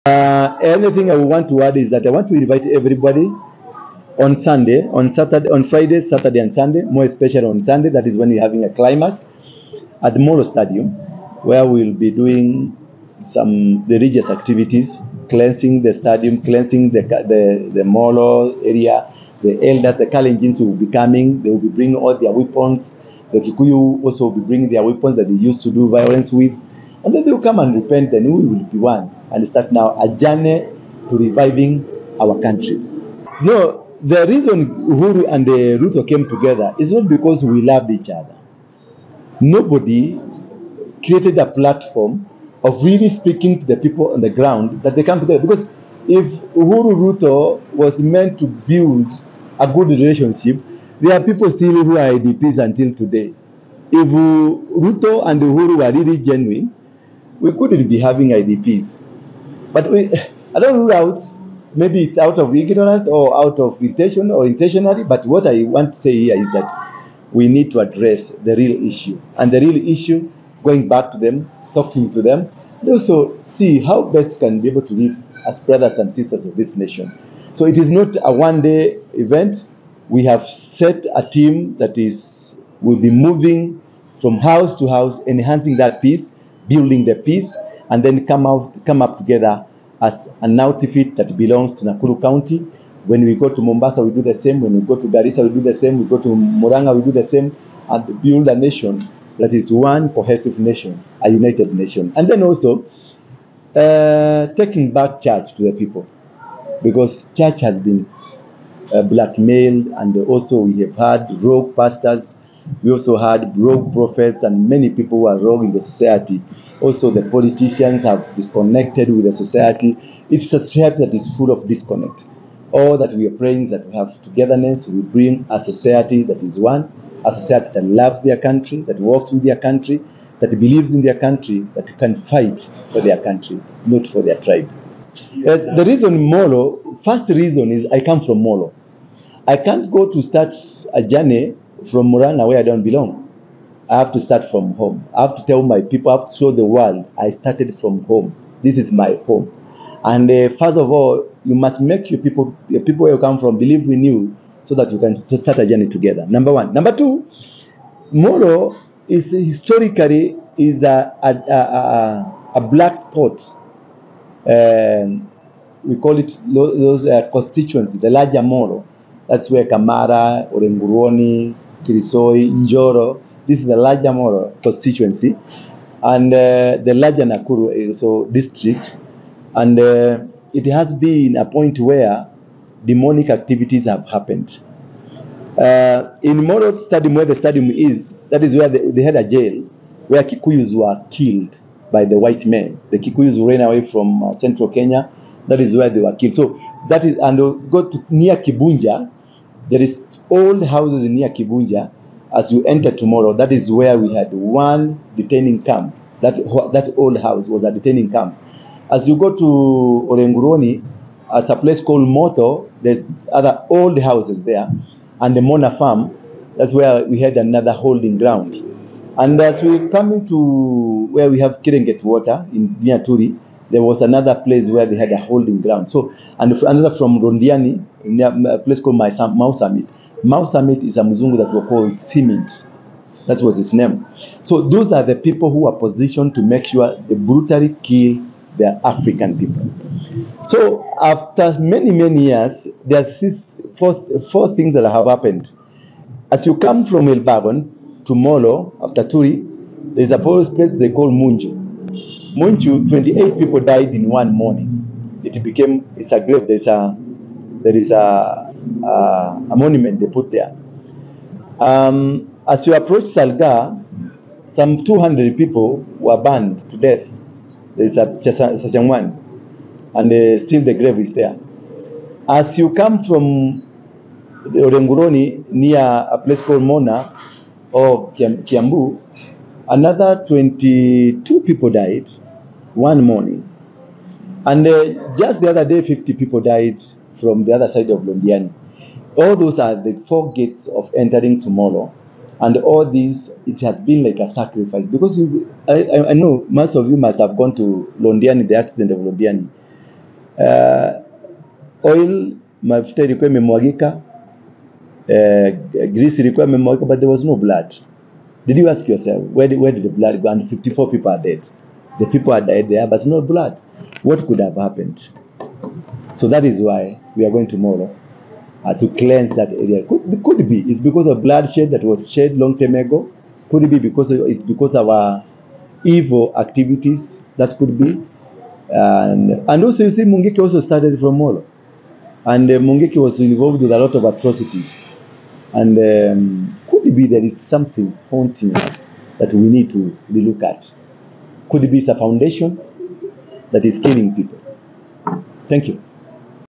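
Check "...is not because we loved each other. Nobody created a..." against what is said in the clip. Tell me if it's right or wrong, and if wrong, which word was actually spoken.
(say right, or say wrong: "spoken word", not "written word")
right.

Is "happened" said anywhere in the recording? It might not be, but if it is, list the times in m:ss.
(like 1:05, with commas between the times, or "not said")
3:04, 4:05, 5:14.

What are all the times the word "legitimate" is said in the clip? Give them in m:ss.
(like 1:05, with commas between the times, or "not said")
not said.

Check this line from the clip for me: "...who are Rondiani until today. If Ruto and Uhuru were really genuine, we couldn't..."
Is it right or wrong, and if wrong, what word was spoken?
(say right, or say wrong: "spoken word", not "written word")
wrong: "IDPs", not "Rondiani".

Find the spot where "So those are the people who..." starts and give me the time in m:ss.
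3:54.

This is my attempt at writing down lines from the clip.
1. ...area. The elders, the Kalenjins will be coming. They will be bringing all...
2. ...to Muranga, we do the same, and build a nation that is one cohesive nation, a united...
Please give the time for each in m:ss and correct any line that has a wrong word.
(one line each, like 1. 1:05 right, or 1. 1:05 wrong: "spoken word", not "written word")
1. 0:18 right
2. 1:36 right.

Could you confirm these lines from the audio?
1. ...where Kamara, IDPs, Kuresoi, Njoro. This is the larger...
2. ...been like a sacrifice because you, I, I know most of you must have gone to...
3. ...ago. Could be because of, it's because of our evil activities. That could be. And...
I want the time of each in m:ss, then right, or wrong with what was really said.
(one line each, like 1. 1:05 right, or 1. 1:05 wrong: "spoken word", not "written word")
1. 2:49 wrong: "Orenguruoni", not "IDPs"
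2. 4:53 right
3. 5:22 right.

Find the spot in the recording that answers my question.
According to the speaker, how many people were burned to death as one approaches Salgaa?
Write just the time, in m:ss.
4:24.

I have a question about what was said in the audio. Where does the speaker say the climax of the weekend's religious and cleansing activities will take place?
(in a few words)
Molo Stadium.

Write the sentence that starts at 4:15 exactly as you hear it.
It became, it's a grave, there's a, there is a, uh, a monument they put there.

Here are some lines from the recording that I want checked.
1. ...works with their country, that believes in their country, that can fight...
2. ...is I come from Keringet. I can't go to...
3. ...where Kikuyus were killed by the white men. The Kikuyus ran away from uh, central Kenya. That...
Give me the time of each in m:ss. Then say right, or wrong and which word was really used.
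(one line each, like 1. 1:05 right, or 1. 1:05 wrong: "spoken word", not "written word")
1. 2:08 right
2. 2:17 wrong: "Molo", not "Keringet"
3. 3:10 right.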